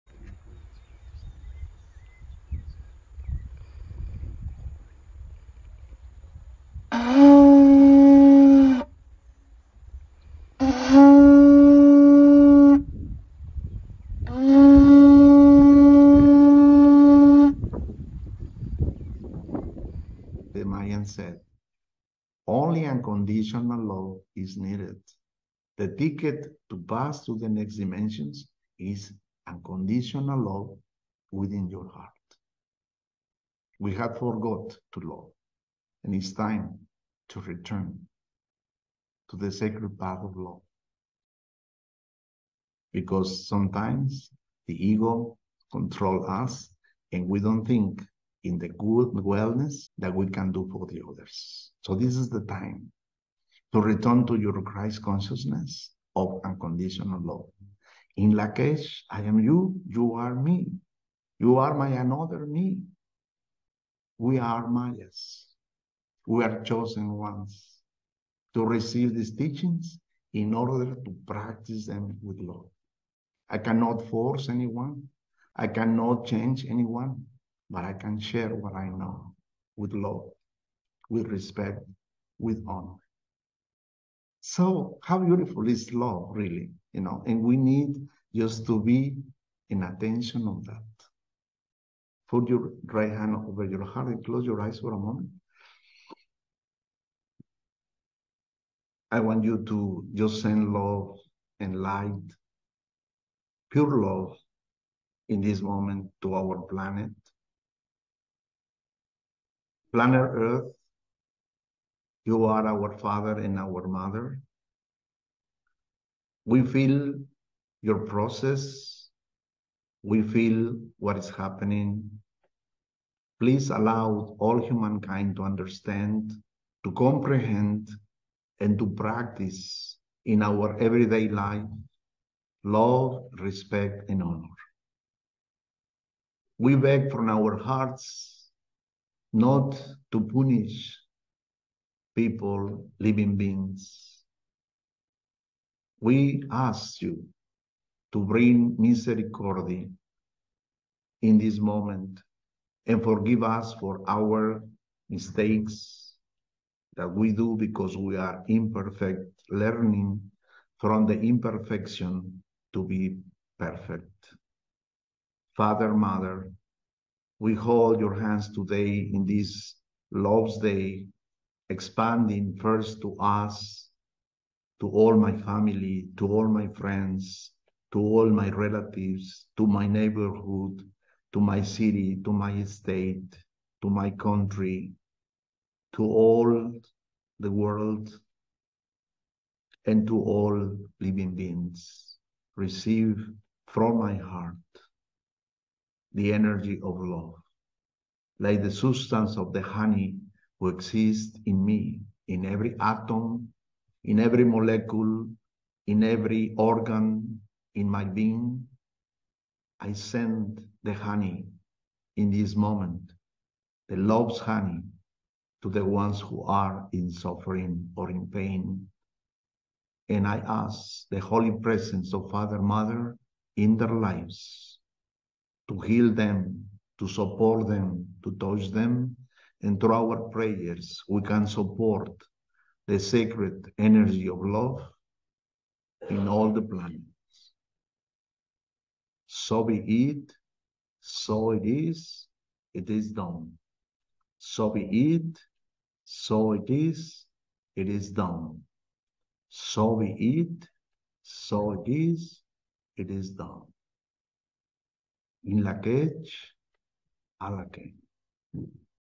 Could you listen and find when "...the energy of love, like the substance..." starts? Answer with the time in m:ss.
3:16.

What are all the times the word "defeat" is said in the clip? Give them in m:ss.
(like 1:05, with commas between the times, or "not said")
not said.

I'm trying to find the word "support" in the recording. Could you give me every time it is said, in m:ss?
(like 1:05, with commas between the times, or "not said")
3:47, 3:51.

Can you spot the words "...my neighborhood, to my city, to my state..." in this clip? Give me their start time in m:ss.
2:59.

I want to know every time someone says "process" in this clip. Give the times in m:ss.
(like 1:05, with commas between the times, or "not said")
1:58.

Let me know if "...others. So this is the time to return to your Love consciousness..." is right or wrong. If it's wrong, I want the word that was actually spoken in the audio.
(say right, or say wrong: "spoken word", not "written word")
wrong: "Christ", not "Love".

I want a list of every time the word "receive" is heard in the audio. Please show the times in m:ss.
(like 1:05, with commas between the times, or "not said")
1:08, 3:12.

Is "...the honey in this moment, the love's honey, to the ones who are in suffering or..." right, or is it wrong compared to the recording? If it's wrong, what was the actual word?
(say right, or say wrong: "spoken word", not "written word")
right.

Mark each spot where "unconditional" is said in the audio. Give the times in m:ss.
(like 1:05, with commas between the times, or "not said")
0:22, 0:29, 0:56.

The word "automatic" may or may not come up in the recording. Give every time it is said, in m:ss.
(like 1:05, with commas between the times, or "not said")
not said.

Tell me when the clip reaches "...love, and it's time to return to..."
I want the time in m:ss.
0:34.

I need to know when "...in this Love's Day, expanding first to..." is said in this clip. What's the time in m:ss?
2:49.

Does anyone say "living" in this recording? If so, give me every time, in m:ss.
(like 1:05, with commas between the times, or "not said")
2:22, 3:10.